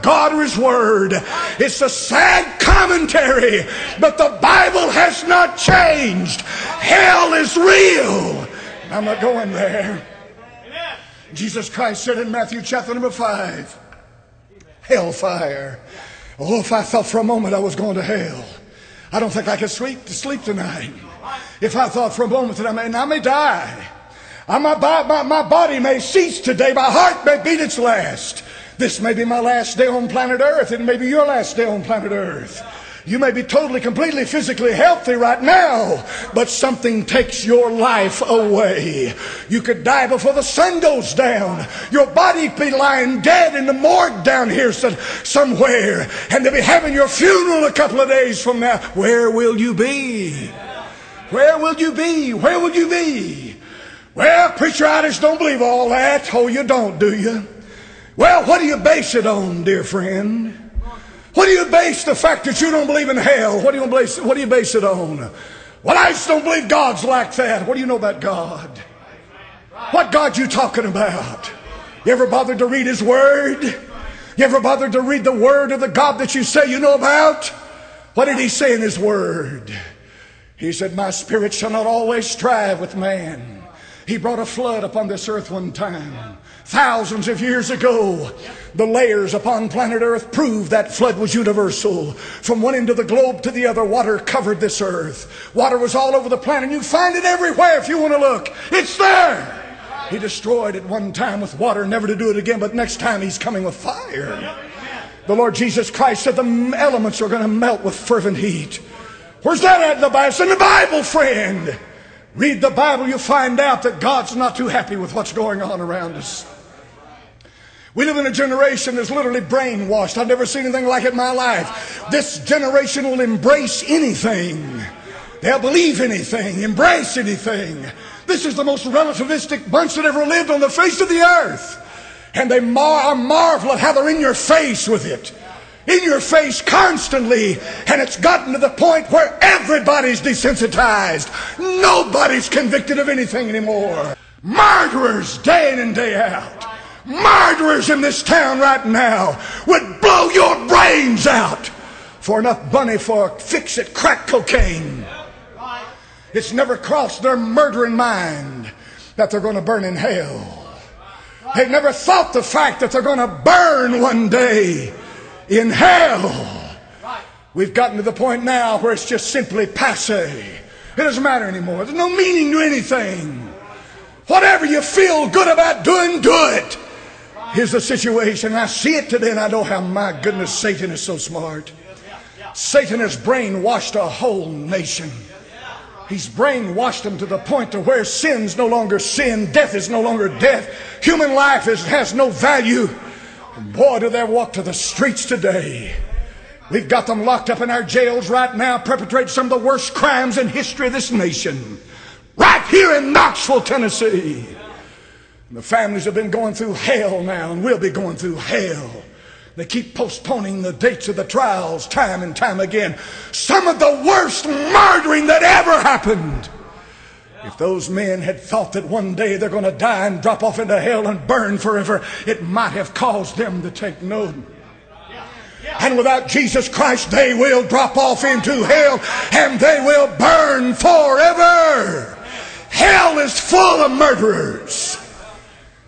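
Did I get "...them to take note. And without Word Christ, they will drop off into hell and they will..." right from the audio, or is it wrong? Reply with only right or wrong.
wrong.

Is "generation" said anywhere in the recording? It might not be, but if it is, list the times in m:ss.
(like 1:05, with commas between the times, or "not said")
1:58, 2:02.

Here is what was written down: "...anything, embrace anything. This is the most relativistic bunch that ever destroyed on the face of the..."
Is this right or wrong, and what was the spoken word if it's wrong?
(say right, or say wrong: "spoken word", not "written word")
wrong: "lived", not "destroyed".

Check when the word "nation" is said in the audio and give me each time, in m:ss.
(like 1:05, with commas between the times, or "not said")
3:04, 3:21.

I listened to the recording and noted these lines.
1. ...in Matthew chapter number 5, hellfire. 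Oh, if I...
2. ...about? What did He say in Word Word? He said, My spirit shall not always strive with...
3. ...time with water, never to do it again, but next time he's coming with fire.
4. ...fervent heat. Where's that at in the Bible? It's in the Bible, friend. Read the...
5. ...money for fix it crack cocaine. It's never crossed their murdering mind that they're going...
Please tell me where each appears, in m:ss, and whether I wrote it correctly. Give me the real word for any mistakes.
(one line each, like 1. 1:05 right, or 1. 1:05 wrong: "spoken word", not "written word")
1. 0:12 right
2. 1:16 wrong: "His", not "Word"
3. 1:41 right
4. 1:47 right
5. 2:32 right.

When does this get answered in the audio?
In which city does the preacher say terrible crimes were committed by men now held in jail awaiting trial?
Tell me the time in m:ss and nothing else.
3:23.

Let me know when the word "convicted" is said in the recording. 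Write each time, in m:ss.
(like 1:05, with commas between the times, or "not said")
2:22.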